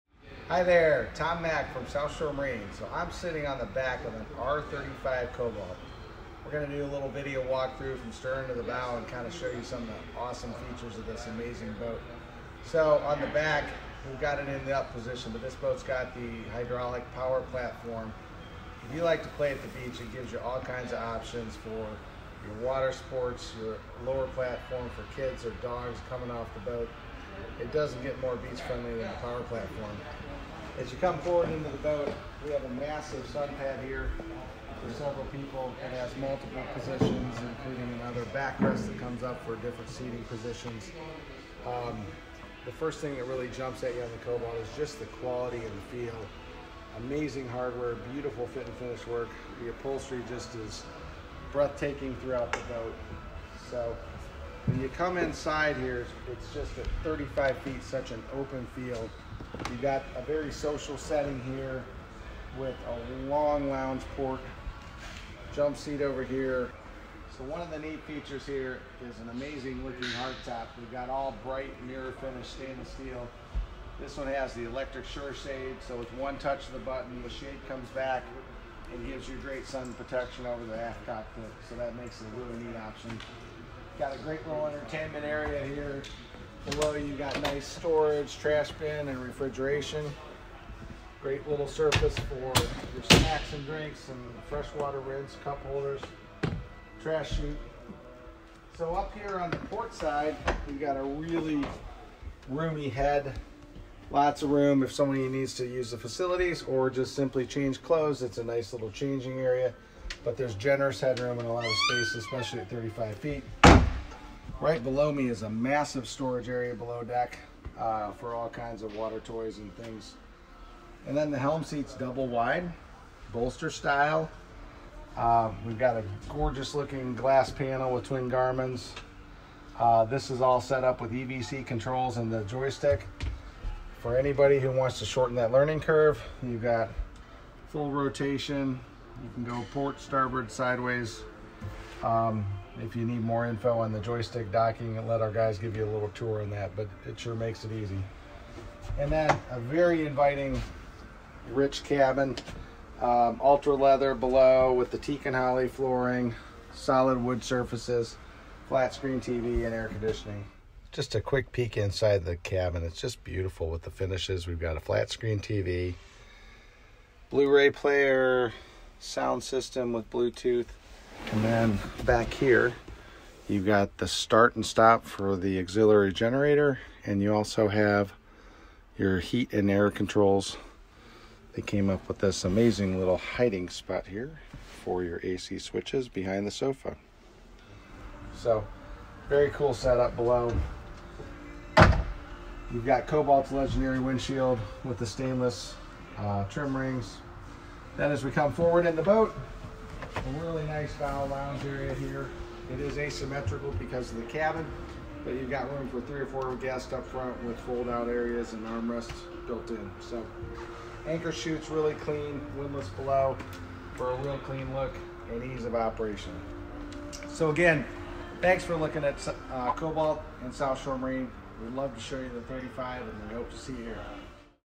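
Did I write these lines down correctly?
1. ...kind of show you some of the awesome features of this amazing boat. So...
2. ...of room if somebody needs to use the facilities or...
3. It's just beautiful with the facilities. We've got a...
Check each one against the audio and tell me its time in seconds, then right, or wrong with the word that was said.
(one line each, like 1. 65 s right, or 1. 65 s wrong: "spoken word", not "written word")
1. 9 s right
2. 104 s right
3. 162 s wrong: "finishes", not "facilities".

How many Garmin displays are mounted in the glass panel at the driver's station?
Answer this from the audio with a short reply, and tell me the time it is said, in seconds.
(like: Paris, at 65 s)
2, at 128 s.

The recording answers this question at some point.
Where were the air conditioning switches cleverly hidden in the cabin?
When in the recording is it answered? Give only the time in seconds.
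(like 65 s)
186 s.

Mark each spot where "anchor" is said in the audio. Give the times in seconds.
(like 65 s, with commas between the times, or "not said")
211 s.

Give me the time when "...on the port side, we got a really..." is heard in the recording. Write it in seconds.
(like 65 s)
99 s.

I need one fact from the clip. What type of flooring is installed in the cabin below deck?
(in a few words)
Teak and holly.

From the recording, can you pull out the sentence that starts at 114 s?
Right below me is a massive storage area below deck uh, for all kinds of water toys and things.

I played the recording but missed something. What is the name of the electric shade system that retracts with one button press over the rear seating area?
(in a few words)
SureShade.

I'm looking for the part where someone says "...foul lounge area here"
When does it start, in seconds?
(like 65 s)
200 s.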